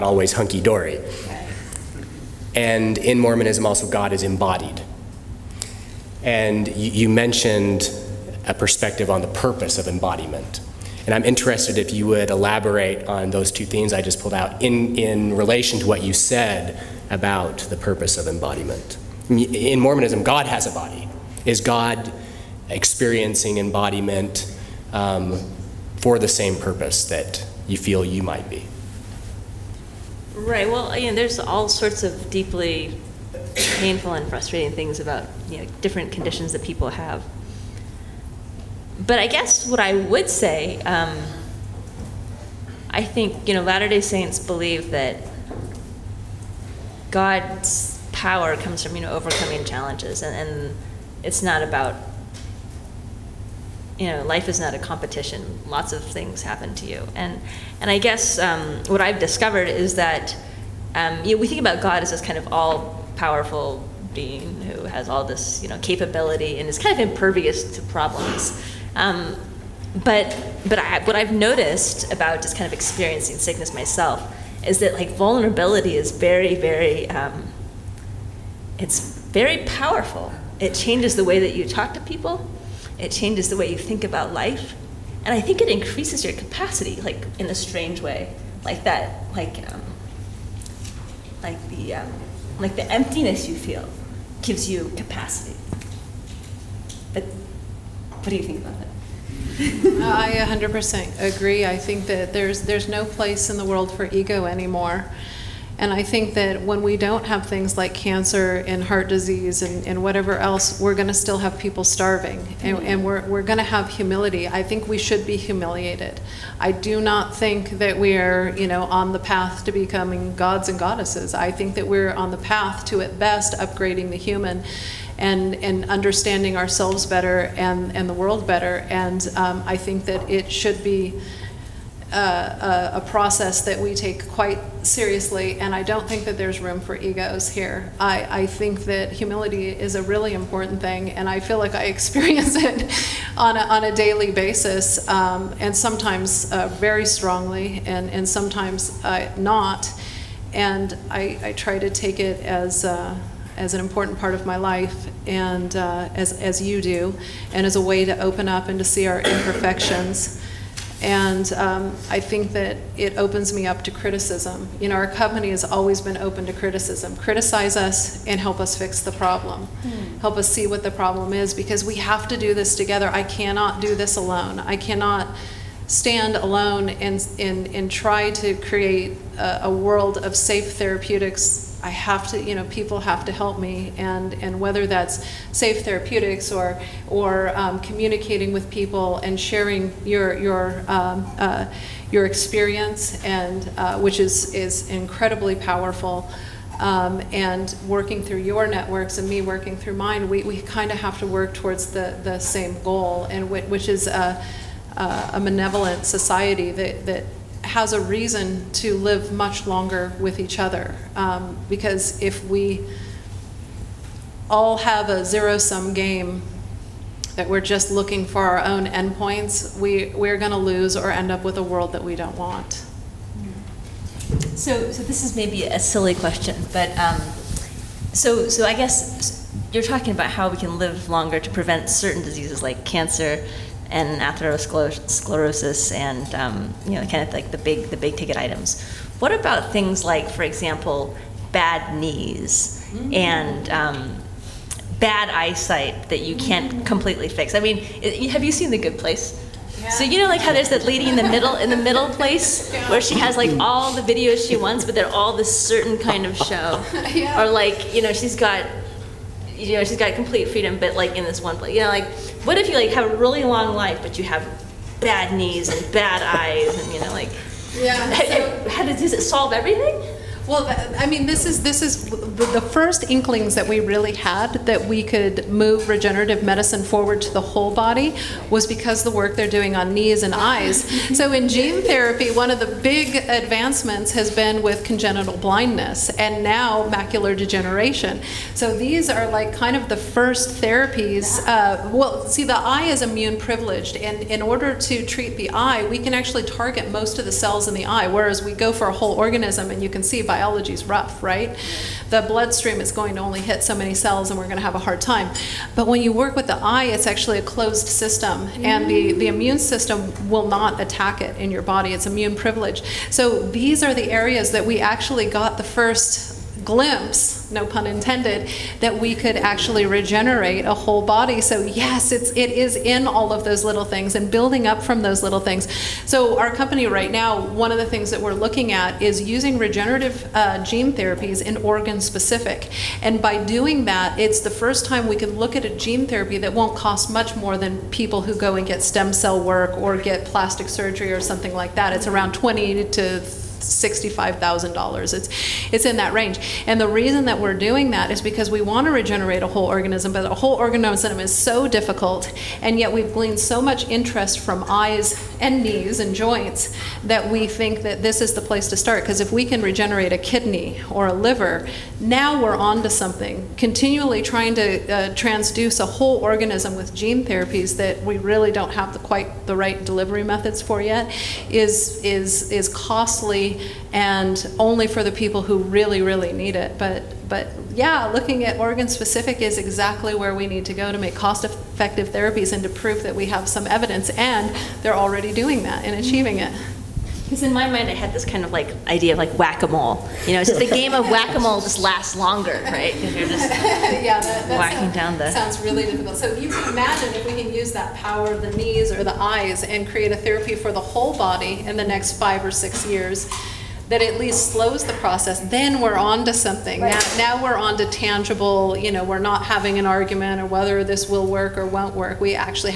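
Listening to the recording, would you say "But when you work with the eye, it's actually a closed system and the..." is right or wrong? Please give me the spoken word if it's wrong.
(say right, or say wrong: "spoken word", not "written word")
right.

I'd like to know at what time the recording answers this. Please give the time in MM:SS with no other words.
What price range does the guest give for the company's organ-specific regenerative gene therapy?
05:42.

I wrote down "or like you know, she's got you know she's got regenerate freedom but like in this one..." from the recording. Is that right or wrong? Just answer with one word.
wrong.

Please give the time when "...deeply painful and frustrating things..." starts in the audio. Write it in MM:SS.
00:32.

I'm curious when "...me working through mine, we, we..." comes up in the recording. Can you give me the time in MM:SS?
03:19.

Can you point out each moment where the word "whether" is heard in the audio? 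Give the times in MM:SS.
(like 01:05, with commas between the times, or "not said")
03:04, 06:50.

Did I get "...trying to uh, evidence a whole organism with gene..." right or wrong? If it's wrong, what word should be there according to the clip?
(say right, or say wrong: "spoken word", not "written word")
wrong: "transduce", not "evidence".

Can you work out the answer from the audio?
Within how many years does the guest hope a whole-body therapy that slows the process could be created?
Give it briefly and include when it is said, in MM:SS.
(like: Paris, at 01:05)
5 or 6 years, at 06:42.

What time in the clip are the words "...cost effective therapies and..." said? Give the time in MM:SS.
06:21.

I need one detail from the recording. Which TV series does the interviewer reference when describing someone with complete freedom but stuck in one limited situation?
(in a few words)
The Good Place.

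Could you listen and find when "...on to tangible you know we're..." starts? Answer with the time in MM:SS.
06:47.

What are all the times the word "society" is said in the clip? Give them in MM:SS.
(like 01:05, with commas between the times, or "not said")
03:26.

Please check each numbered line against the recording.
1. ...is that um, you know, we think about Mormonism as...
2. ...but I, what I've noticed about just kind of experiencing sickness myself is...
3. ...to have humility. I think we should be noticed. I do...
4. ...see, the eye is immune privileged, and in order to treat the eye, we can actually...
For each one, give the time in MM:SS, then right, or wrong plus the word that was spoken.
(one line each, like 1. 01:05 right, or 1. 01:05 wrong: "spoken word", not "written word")
1. 00:59 wrong: "God", not "Mormonism"
2. 01:10 right
3. 01:53 wrong: "humiliated", not "noticed"
4. 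04:52 right.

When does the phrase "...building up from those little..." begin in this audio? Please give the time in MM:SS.
05:24.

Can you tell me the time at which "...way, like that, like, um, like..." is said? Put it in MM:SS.
01:27.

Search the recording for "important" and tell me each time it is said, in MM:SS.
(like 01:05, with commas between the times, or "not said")
02:20, 02:33.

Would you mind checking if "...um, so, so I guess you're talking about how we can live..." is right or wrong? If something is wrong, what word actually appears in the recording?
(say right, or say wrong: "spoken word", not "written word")
right.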